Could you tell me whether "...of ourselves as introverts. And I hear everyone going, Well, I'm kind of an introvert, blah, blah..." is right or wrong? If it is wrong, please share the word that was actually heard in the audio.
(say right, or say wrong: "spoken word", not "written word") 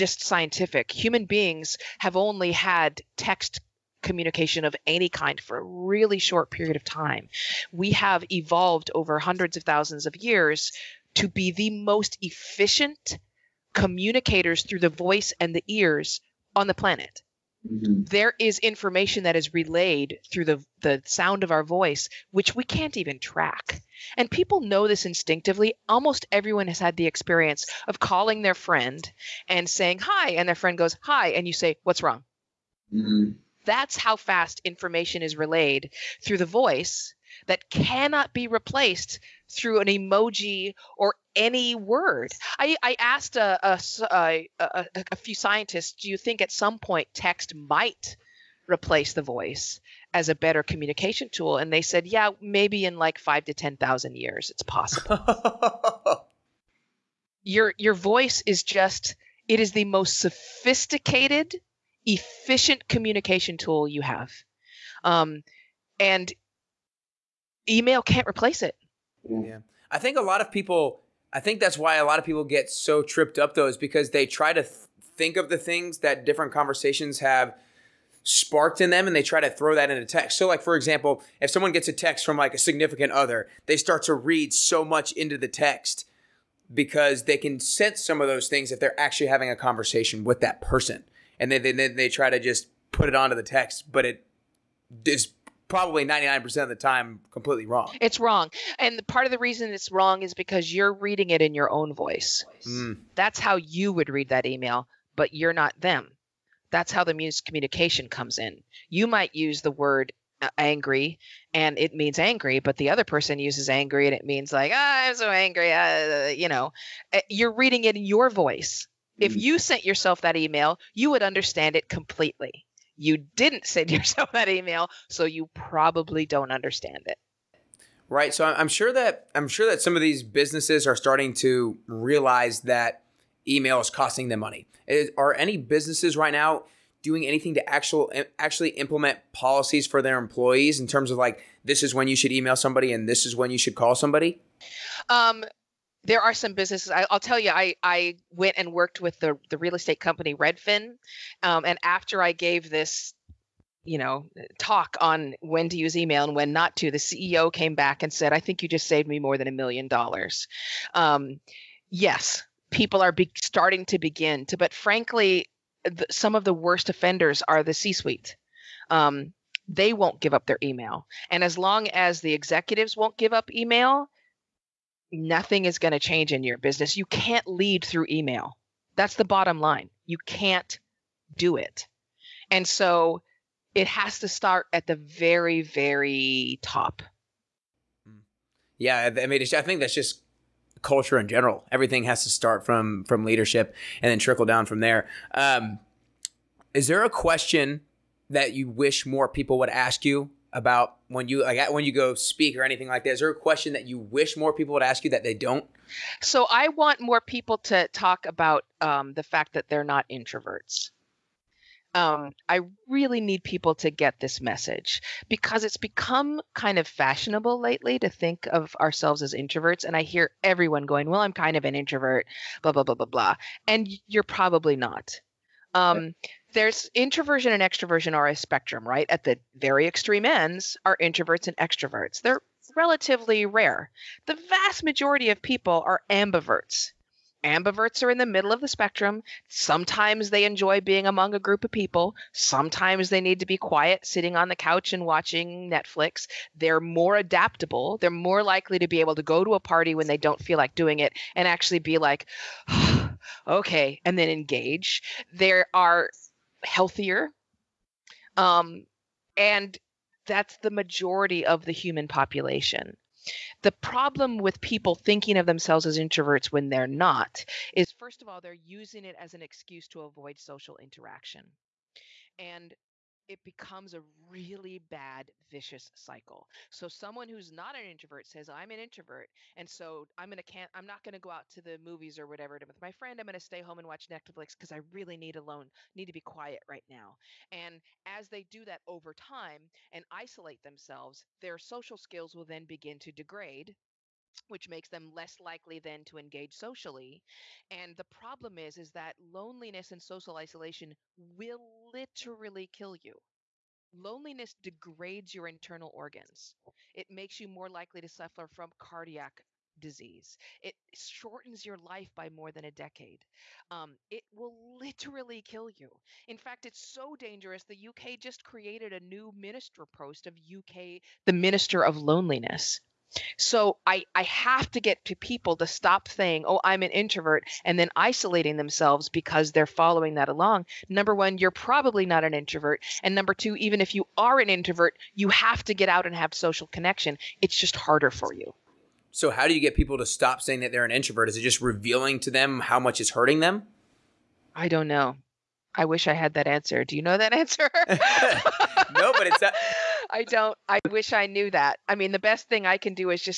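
right.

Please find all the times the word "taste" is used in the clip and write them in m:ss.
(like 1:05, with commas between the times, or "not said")
not said.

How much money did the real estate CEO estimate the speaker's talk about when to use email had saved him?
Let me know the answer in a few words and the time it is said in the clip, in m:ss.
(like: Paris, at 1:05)
More than $1 million, at 2:39.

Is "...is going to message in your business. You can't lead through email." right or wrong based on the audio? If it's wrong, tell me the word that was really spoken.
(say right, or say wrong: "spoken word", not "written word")
wrong: "change", not "message".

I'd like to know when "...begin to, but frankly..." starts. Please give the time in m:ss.
2:43.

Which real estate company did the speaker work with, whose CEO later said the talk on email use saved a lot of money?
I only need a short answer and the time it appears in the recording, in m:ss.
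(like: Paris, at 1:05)
Redfin, at 2:30.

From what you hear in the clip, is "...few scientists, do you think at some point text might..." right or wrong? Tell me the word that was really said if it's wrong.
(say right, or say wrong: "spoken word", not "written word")
right.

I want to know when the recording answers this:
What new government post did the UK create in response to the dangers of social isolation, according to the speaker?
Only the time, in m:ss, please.
5:21.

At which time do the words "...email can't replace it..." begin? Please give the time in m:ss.
1:07.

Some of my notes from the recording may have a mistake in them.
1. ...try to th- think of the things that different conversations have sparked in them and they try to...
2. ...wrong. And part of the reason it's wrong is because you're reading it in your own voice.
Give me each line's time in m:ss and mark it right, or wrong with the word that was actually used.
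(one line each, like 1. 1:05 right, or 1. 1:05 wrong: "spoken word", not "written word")
1. 1:14 right
2. 1:38 right.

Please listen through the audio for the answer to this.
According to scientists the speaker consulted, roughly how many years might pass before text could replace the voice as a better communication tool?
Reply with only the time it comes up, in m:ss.
0:53.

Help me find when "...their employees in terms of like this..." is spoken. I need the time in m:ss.
2:20.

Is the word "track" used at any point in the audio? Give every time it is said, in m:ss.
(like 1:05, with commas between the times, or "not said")
0:23.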